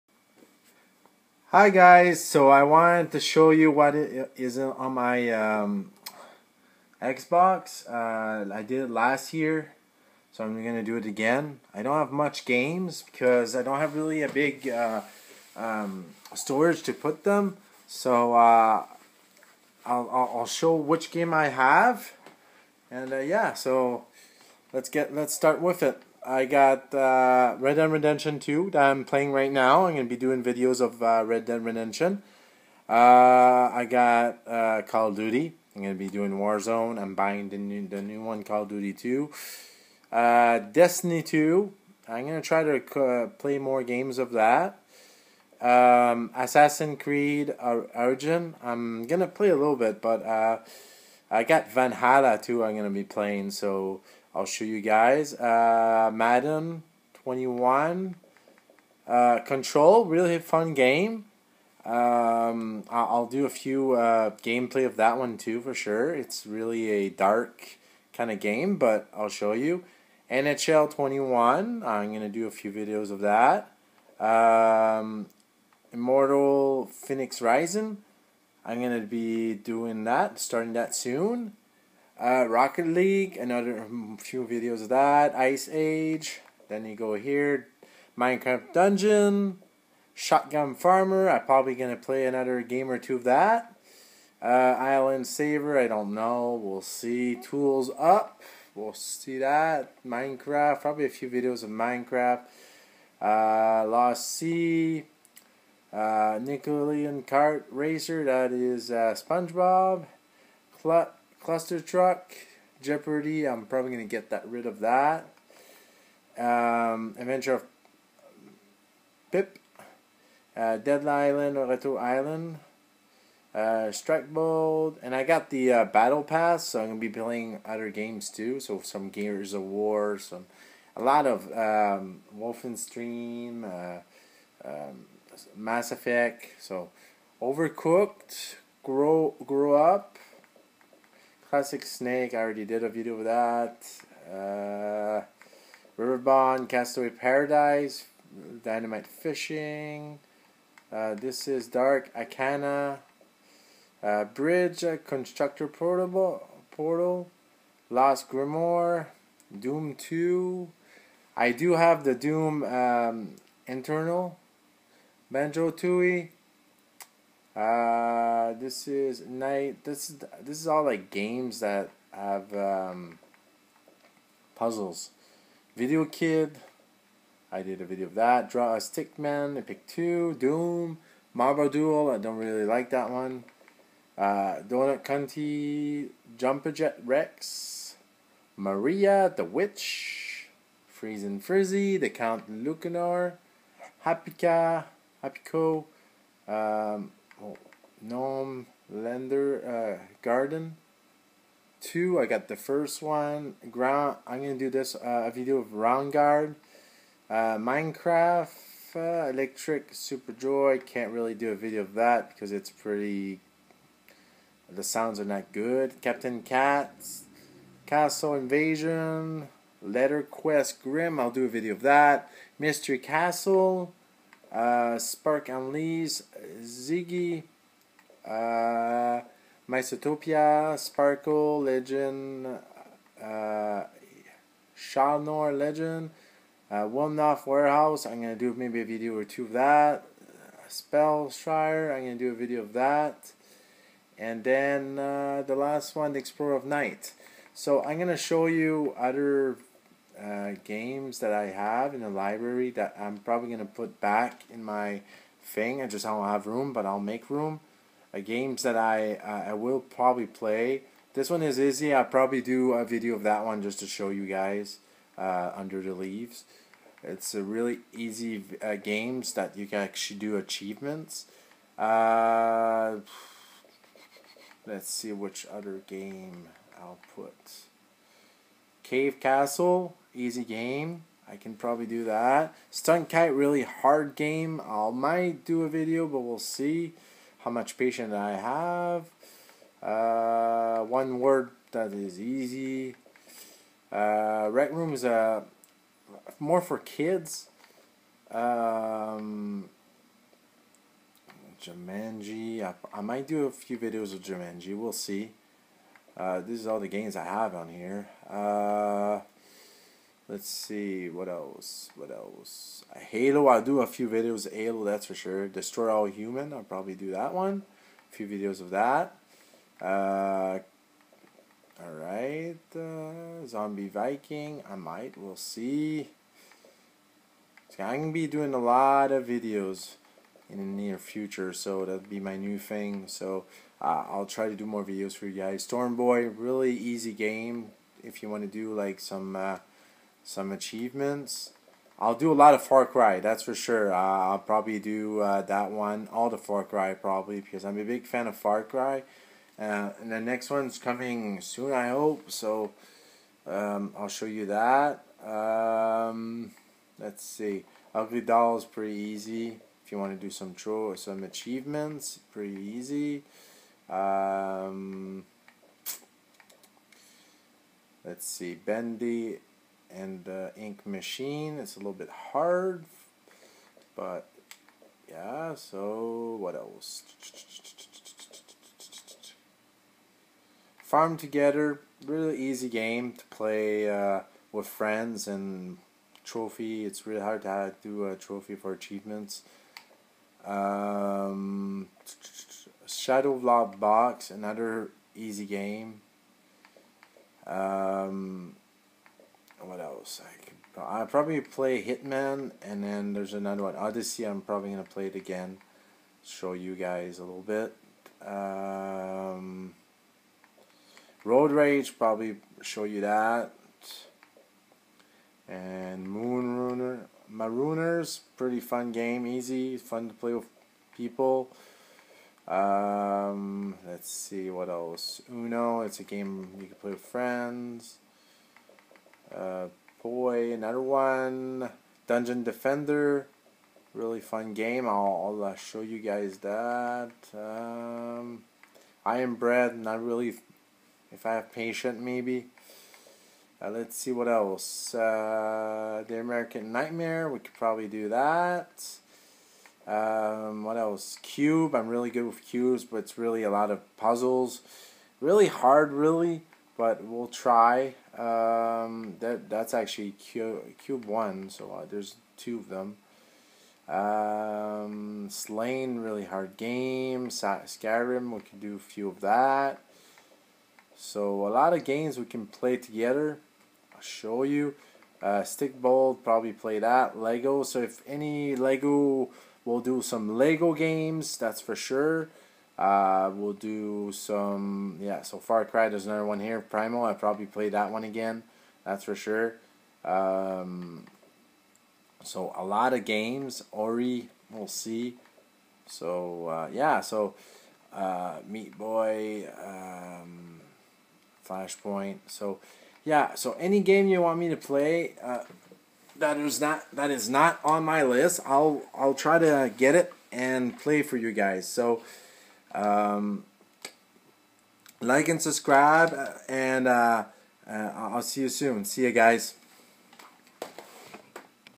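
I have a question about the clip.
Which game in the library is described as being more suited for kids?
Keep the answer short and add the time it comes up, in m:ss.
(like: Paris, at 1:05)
Rec Room, at 4:54.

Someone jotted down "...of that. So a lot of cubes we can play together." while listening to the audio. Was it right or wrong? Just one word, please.
wrong.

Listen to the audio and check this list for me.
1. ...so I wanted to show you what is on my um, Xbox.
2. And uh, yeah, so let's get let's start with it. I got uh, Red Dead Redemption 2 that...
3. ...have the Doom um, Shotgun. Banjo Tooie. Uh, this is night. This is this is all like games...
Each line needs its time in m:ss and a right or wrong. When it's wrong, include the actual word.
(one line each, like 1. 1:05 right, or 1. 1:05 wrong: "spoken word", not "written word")
1. 0:02 right
2. 0:22 right
3. 2:41 wrong: "Eternal", not "Shotgun".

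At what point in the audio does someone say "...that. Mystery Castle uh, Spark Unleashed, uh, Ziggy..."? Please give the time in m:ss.
3:41.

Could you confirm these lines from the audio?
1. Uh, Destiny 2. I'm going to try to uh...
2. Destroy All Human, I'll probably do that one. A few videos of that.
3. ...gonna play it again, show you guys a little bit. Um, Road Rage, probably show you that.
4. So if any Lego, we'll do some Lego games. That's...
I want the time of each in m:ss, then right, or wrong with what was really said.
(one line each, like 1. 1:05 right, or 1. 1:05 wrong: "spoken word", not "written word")
1. 0:40 right
2. 5:15 right
3. 6:44 right
4. 7:57 right.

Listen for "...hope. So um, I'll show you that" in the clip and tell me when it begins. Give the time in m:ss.
5:51.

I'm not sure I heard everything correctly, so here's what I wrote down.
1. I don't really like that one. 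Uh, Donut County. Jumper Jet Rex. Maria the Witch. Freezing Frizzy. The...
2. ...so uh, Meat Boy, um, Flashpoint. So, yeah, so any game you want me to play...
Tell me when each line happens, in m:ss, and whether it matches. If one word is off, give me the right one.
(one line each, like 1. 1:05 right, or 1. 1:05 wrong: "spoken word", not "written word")
1. 3:02 right
2. 8:17 right.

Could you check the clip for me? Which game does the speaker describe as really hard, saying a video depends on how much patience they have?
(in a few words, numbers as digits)
Stunt Kite.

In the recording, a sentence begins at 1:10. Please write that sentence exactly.
NHL 21, I'm going to do a few videos of that.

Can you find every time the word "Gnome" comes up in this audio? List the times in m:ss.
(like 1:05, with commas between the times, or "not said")
3:18.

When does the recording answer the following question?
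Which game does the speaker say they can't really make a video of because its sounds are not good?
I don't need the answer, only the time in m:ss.
3:29.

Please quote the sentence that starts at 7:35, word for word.
Really hard, really, but we'll try.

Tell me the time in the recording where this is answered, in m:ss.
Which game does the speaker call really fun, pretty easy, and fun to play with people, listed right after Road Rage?
6:57.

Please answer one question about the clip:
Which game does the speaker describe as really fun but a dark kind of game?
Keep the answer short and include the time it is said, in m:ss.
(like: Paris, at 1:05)
Control, at 0:59.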